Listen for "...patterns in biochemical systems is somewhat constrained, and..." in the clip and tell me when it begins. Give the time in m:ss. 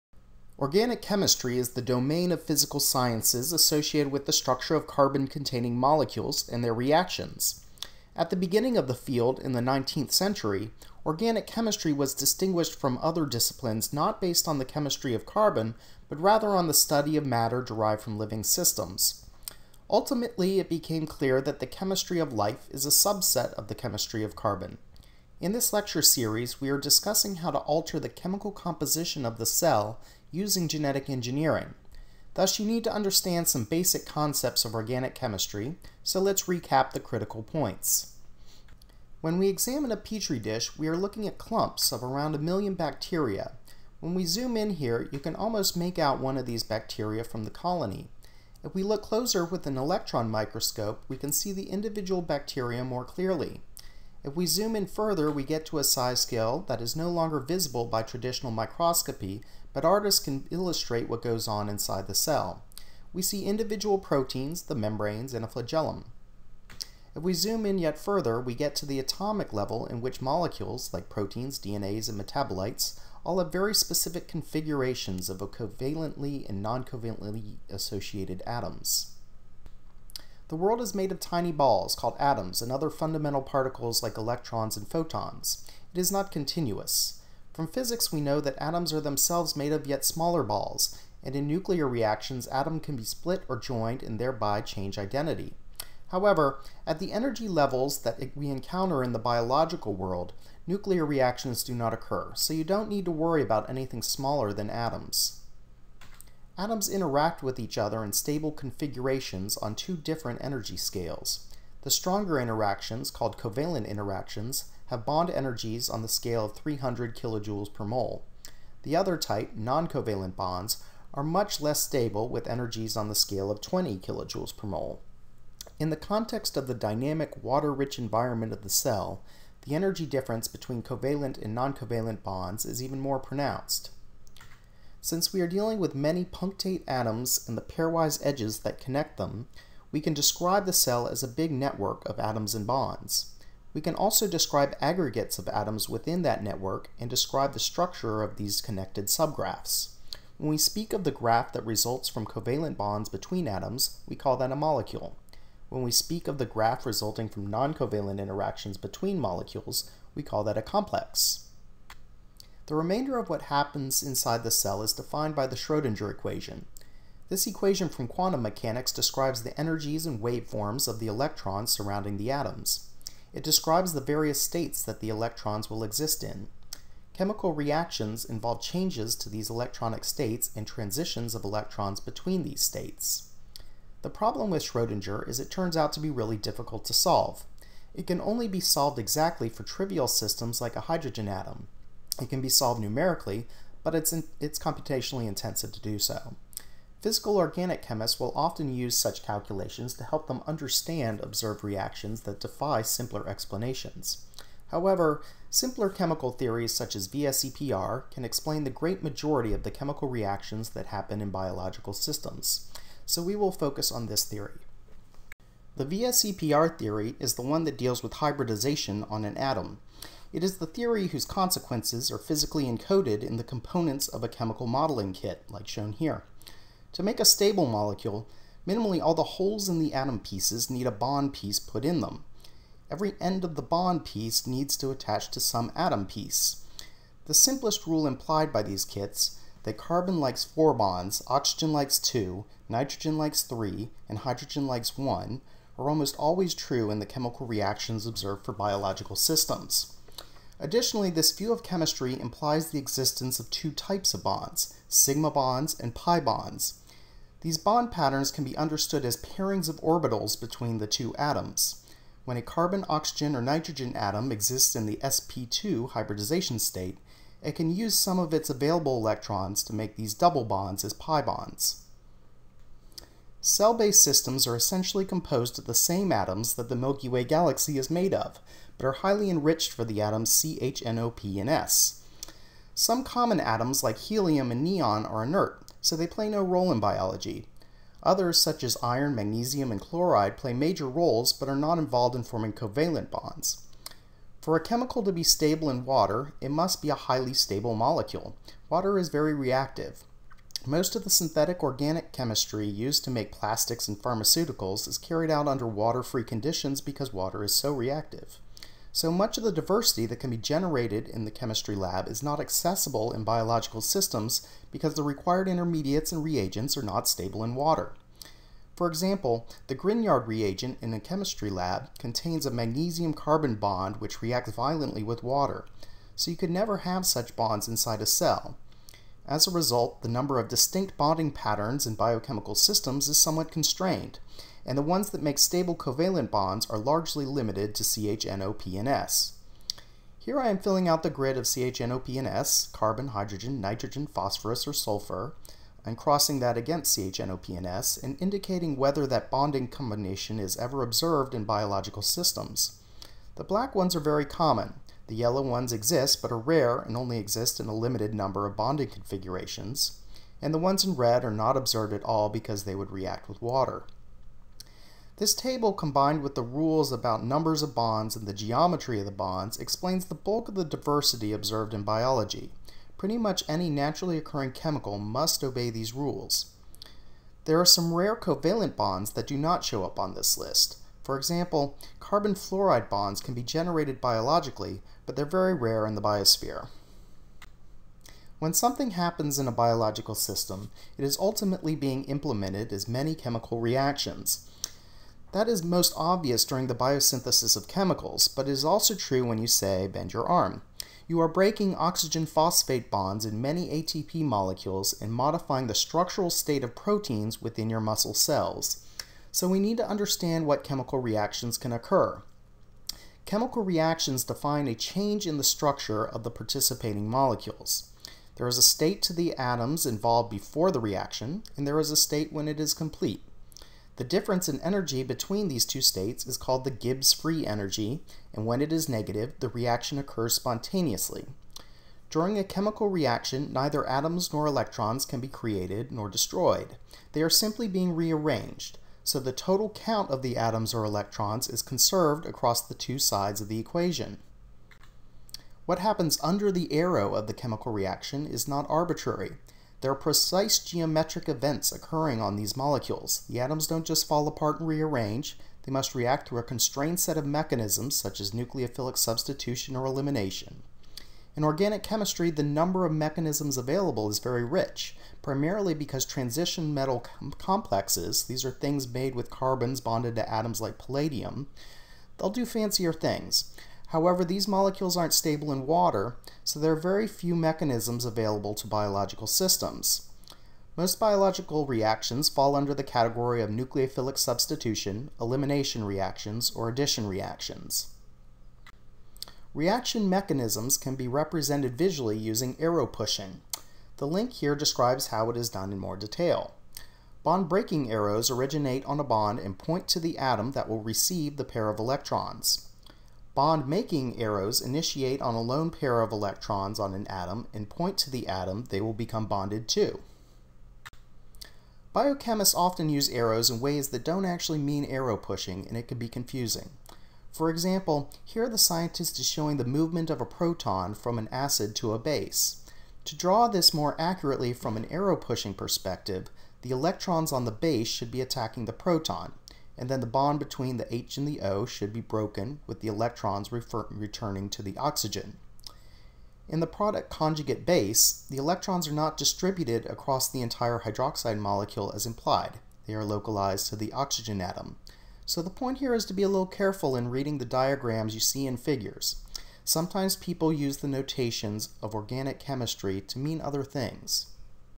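5:31.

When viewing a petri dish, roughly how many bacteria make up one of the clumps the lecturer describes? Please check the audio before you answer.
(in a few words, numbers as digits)
1,000,000.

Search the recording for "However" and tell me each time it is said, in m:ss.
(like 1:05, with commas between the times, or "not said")
1:36, 3:24, 7:53.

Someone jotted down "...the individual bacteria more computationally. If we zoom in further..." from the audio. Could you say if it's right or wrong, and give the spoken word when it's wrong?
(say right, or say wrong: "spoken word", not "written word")
wrong: "clearly", not "computationally".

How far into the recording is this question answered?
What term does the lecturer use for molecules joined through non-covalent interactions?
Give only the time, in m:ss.
2:40.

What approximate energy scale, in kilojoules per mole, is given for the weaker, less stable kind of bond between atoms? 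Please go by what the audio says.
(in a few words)
20.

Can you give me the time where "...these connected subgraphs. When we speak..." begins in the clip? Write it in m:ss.
2:28.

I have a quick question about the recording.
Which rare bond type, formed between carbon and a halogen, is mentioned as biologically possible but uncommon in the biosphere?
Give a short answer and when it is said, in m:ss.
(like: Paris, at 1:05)
carbon fluoride, at 6:21.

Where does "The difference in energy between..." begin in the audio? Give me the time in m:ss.
7:03.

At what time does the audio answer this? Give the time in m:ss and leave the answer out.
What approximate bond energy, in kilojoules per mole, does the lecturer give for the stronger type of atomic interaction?
1:56.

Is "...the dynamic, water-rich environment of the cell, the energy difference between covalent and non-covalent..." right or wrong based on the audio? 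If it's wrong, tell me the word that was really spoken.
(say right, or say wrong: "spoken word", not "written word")
right.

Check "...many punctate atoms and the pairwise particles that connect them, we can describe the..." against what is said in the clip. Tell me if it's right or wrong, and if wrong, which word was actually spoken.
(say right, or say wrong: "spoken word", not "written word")
wrong: "edges", not "particles".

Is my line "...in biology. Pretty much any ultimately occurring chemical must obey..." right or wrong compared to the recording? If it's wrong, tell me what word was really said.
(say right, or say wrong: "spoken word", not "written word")
wrong: "naturally", not "ultimately".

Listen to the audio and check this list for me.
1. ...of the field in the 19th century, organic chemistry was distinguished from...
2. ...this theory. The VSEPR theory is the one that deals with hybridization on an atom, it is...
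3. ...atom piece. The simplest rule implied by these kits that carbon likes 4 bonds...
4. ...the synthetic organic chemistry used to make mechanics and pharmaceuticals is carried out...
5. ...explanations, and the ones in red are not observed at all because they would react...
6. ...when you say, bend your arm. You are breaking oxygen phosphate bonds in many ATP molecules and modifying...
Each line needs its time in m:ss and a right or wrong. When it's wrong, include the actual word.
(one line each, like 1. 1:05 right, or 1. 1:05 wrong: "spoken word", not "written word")
1. 0:08 right
2. 3:34 right
3. 3:55 right
4. 5:01 wrong: "plastics", not "mechanics"
5. 5:58 wrong: "configurations", not "explanations"
6. 6:39 right.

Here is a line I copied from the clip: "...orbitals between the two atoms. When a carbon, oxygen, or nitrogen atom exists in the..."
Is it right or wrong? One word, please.
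right.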